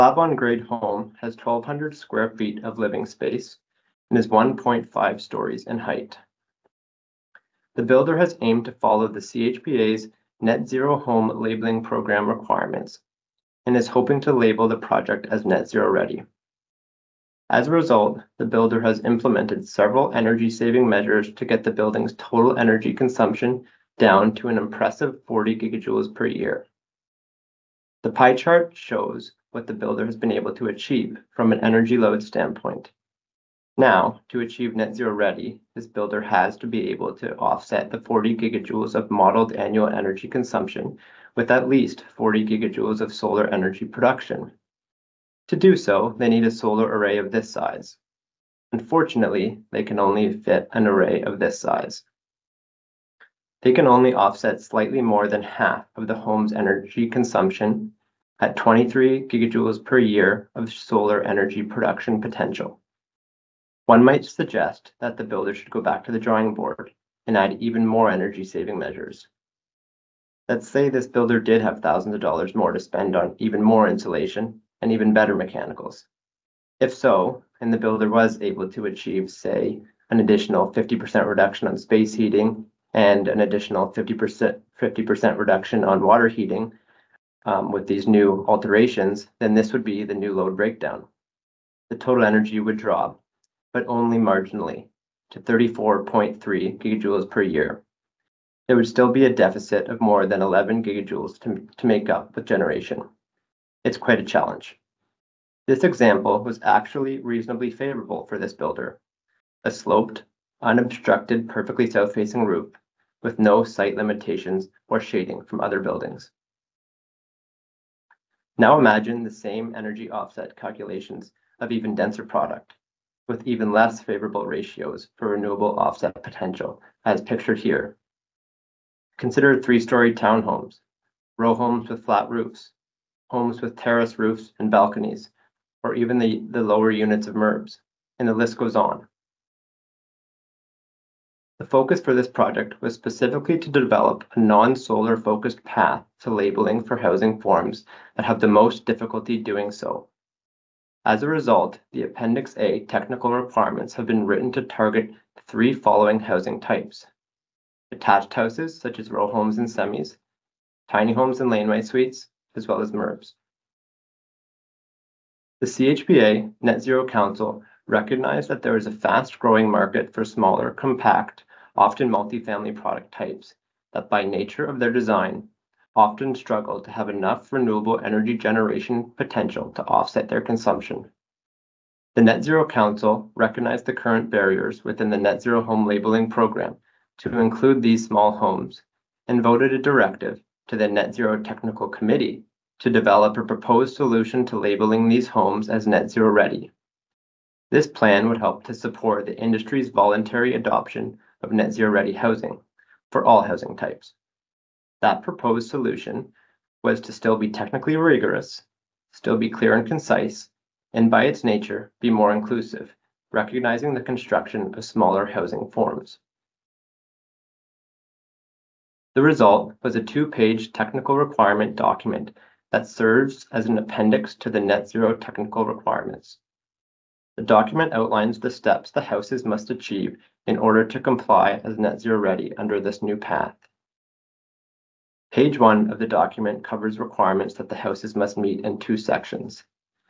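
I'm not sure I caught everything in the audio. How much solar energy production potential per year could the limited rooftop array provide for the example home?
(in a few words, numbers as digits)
23 gigajoules.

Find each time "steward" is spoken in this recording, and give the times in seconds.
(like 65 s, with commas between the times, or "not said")
not said.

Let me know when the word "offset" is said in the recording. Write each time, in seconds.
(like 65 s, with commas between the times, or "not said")
37 s, 54 s, 120 s, 125 s, 179 s.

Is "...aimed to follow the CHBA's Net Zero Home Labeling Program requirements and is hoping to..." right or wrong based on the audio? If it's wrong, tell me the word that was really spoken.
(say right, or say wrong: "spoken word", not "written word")
right.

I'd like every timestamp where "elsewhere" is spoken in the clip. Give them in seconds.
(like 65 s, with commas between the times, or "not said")
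not said.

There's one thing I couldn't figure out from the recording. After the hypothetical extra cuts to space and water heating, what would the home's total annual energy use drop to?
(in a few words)
34.3 gigajoules.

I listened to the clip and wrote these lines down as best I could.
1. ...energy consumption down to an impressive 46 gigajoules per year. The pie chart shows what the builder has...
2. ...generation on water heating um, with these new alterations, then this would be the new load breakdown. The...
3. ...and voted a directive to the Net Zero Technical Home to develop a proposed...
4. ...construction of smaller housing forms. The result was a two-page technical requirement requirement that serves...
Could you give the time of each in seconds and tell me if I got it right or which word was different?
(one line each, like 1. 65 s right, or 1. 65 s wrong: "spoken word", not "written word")
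1. 22 s wrong: "40", not "46"
2. 85 s wrong: "reduction", not "generation"
3. 189 s wrong: "Committee", not "Home"
4. 214 s wrong: "document", not "requirement".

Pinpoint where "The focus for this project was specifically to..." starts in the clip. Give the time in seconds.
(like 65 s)
141 s.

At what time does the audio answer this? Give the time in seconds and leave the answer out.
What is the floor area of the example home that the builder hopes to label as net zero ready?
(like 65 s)
1 s.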